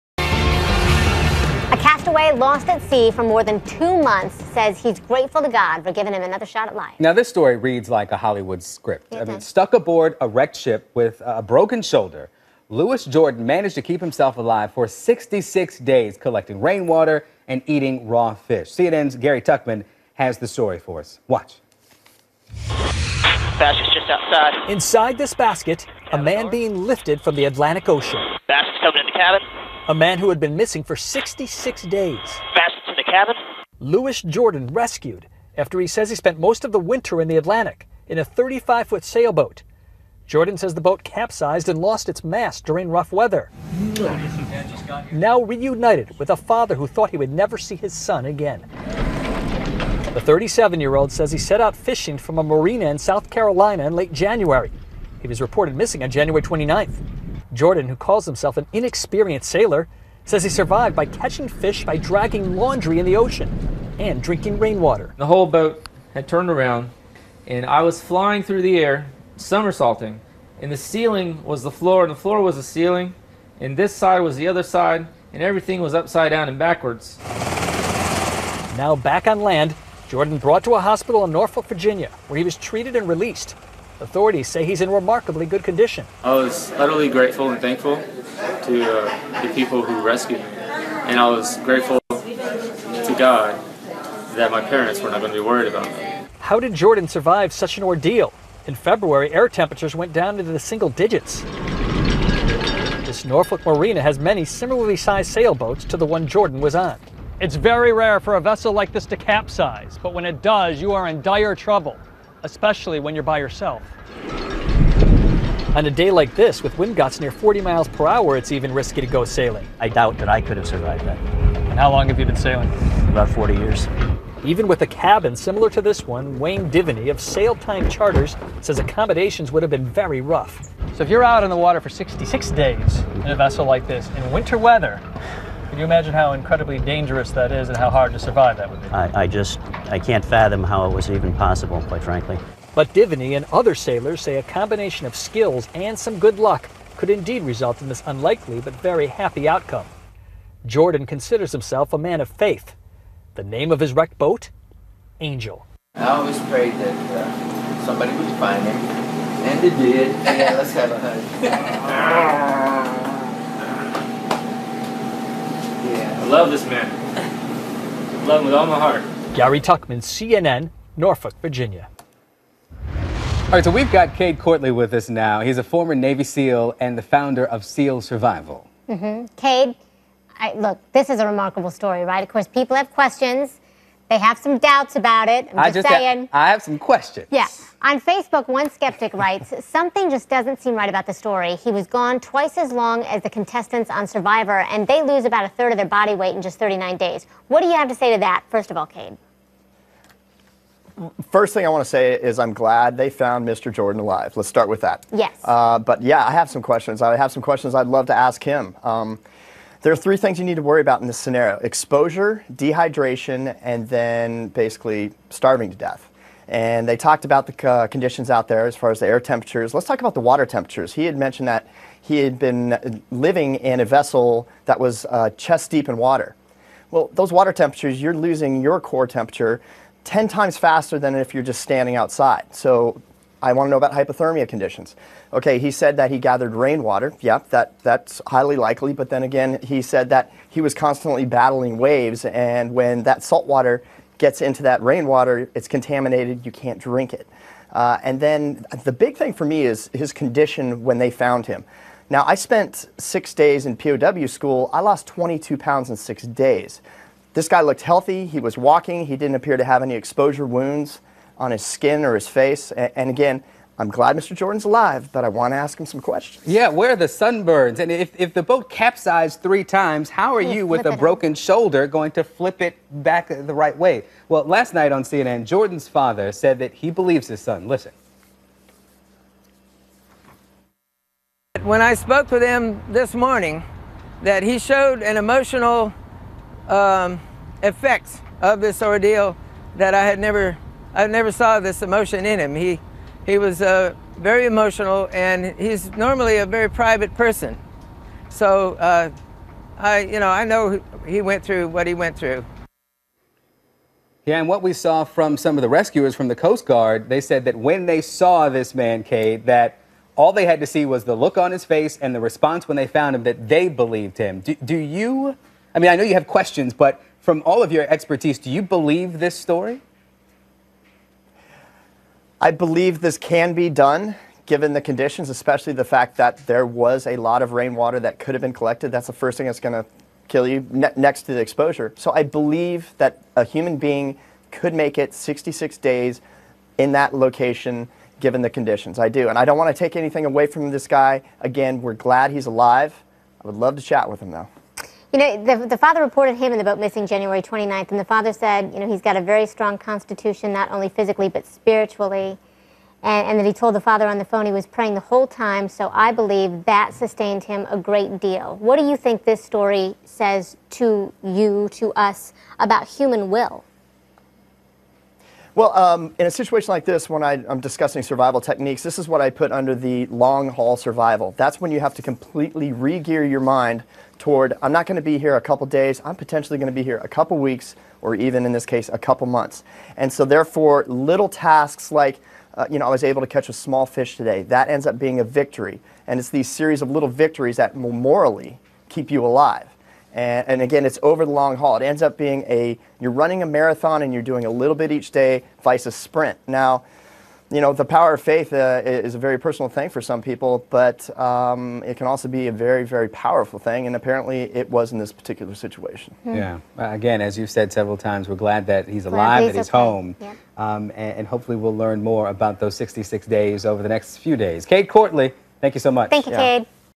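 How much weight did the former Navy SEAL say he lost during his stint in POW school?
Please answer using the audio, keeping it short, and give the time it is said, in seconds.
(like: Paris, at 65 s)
22 pounds, at 255 s.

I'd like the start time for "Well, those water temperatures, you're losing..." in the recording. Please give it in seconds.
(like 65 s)
226 s.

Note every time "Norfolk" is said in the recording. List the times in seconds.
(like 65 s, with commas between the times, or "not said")
81 s, 103 s, 170 s.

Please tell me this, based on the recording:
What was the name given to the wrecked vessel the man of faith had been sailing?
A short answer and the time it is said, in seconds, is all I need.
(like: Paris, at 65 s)
Angel, at 155 s.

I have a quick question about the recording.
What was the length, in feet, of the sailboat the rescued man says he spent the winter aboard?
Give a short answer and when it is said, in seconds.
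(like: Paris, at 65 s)
35, at 38 s.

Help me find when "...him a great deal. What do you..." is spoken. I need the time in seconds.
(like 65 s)
357 s.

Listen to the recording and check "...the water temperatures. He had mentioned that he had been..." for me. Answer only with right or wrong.
right.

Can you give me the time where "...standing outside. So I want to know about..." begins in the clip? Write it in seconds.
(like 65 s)
231 s.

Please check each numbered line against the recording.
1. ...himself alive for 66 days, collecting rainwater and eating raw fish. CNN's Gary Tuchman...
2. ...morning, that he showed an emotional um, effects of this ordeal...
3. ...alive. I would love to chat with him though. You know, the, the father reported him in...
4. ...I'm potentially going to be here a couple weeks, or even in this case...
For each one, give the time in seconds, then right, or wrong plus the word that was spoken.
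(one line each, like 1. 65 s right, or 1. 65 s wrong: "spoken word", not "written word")
1. 13 s right
2. 283 s right
3. 342 s right
4. 376 s right.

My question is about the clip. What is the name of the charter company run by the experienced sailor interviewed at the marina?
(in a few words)
Sail Time Charters.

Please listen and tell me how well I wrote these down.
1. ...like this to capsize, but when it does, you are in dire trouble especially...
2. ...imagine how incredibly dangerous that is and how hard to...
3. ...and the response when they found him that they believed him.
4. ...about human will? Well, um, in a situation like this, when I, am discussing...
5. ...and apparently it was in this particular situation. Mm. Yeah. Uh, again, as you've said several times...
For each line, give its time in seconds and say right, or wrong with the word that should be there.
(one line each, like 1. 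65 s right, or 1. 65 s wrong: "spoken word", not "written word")
1. 108 s right
2. 135 s right
3. 312 s right
4. 362 s right
5. 403 s right.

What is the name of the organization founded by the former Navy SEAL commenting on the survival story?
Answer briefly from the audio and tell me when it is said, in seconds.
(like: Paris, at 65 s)
SEAL Survival, at 177 s.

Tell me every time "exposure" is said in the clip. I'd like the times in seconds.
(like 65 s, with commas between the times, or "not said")
211 s, 259 s, 331 s.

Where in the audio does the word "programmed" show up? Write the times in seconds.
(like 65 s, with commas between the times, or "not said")
not said.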